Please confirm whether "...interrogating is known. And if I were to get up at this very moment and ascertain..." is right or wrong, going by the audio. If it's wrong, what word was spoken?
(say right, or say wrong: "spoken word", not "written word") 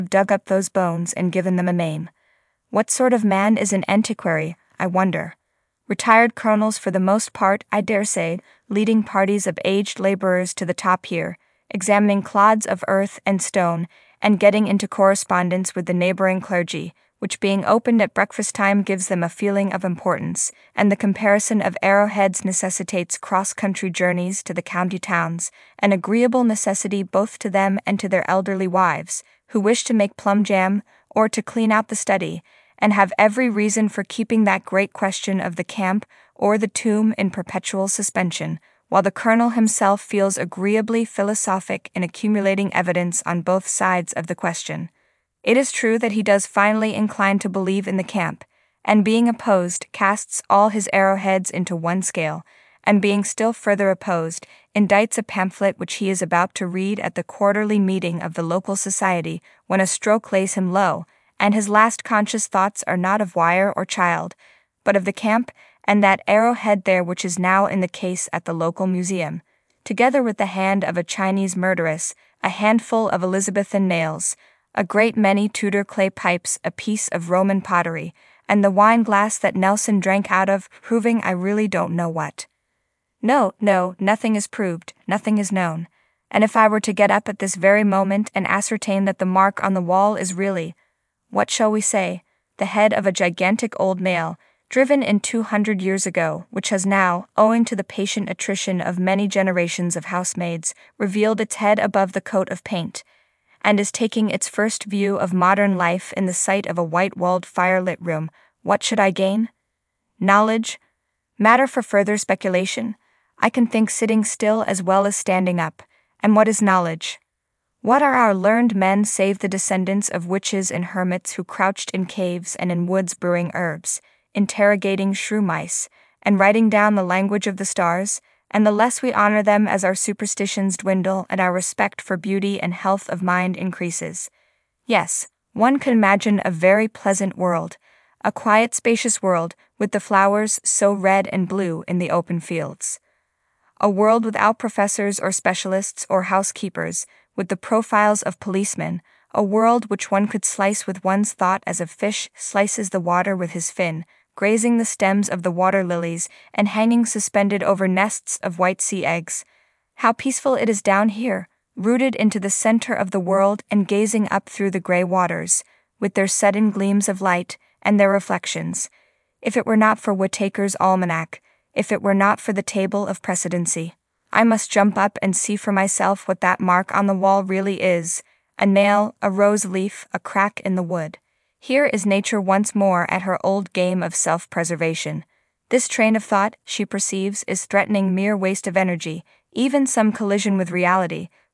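wrong: "nothing", not "interrogating".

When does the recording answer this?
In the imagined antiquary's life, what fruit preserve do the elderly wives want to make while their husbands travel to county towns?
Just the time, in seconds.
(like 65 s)
30 s.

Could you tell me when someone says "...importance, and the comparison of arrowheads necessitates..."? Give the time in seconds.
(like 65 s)
19 s.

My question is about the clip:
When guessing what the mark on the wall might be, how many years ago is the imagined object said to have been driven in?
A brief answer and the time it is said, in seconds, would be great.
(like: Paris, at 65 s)
200, at 95 s.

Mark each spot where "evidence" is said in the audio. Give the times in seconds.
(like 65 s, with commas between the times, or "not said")
42 s.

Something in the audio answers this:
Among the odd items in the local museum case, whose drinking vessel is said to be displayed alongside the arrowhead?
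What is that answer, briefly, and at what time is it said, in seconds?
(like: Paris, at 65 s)
Nelson, at 79 s.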